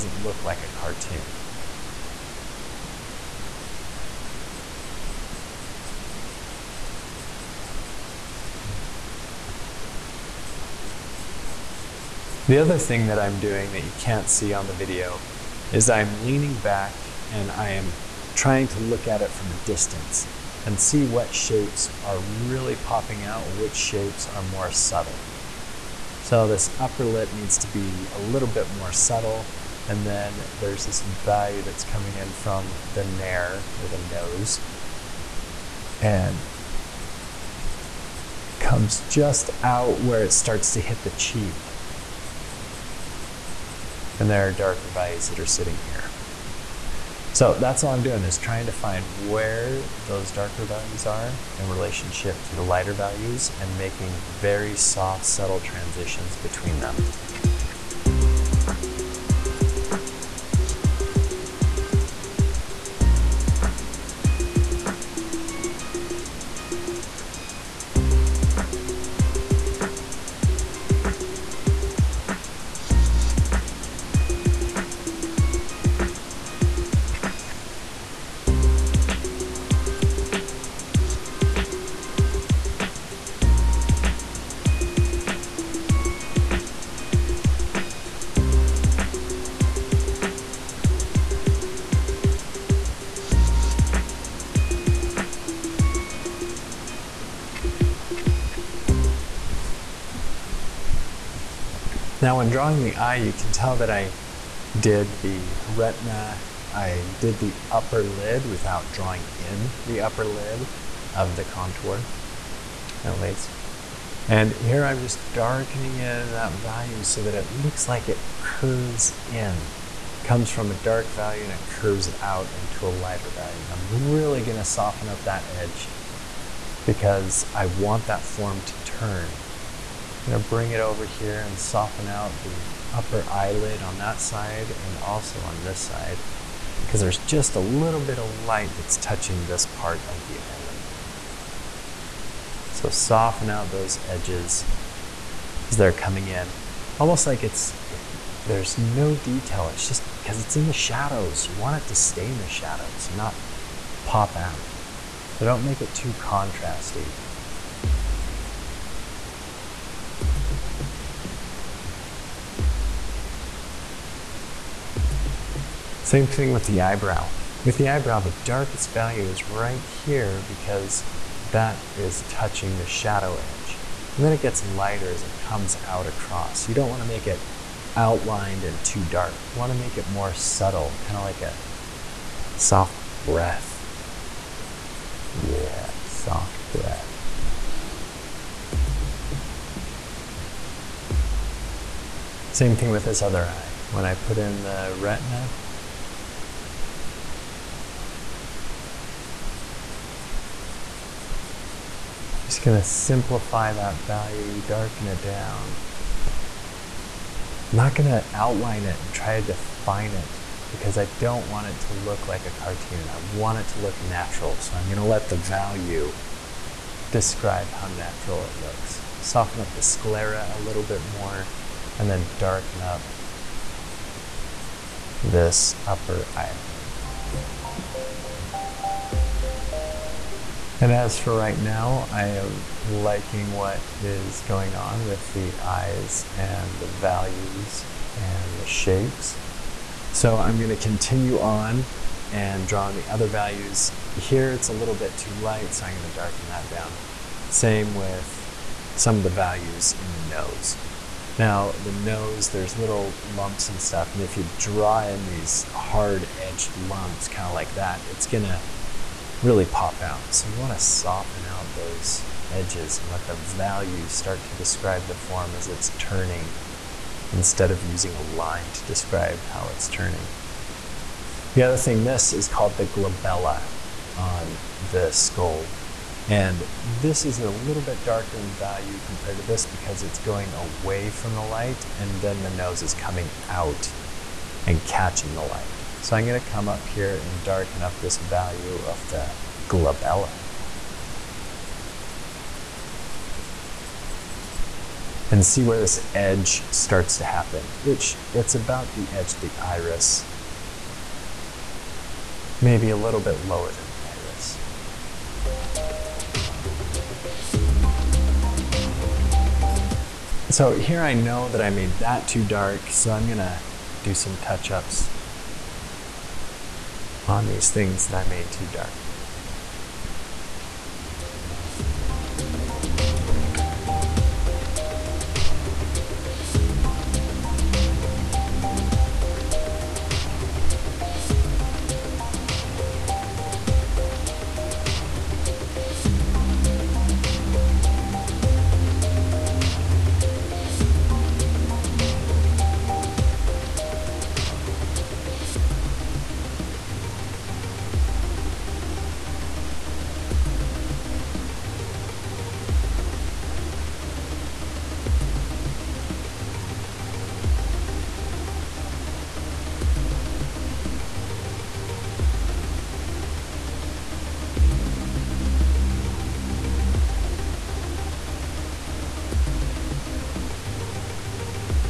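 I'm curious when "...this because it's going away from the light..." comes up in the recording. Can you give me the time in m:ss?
4:39.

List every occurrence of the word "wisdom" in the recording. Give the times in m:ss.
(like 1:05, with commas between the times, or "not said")
not said.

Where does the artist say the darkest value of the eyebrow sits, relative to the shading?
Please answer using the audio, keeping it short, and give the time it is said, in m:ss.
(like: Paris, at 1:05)
the shadow edge, at 2:52.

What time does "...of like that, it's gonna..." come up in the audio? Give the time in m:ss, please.
4:17.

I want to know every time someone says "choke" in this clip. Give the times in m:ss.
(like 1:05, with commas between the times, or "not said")
not said.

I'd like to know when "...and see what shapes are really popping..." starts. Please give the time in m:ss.
0:20.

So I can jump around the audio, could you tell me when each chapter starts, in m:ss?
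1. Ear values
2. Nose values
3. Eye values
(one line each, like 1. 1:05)
1. 0:57
2. 4:07
3. 1:27.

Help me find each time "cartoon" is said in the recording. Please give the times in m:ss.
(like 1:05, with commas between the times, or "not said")
0:00, 3:32.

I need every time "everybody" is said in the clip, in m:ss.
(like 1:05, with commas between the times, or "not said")
not said.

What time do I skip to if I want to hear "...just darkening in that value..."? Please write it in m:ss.
1:55.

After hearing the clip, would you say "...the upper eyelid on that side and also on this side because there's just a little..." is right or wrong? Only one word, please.
right.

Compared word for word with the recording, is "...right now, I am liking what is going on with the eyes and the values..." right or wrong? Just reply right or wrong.
right.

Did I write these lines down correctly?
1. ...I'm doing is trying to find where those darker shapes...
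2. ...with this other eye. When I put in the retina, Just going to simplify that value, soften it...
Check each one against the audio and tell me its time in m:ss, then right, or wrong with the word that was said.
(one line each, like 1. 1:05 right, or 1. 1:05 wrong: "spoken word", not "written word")
1. 0:47 wrong: "values", not "shapes"
2. 3:12 wrong: "darken", not "soften".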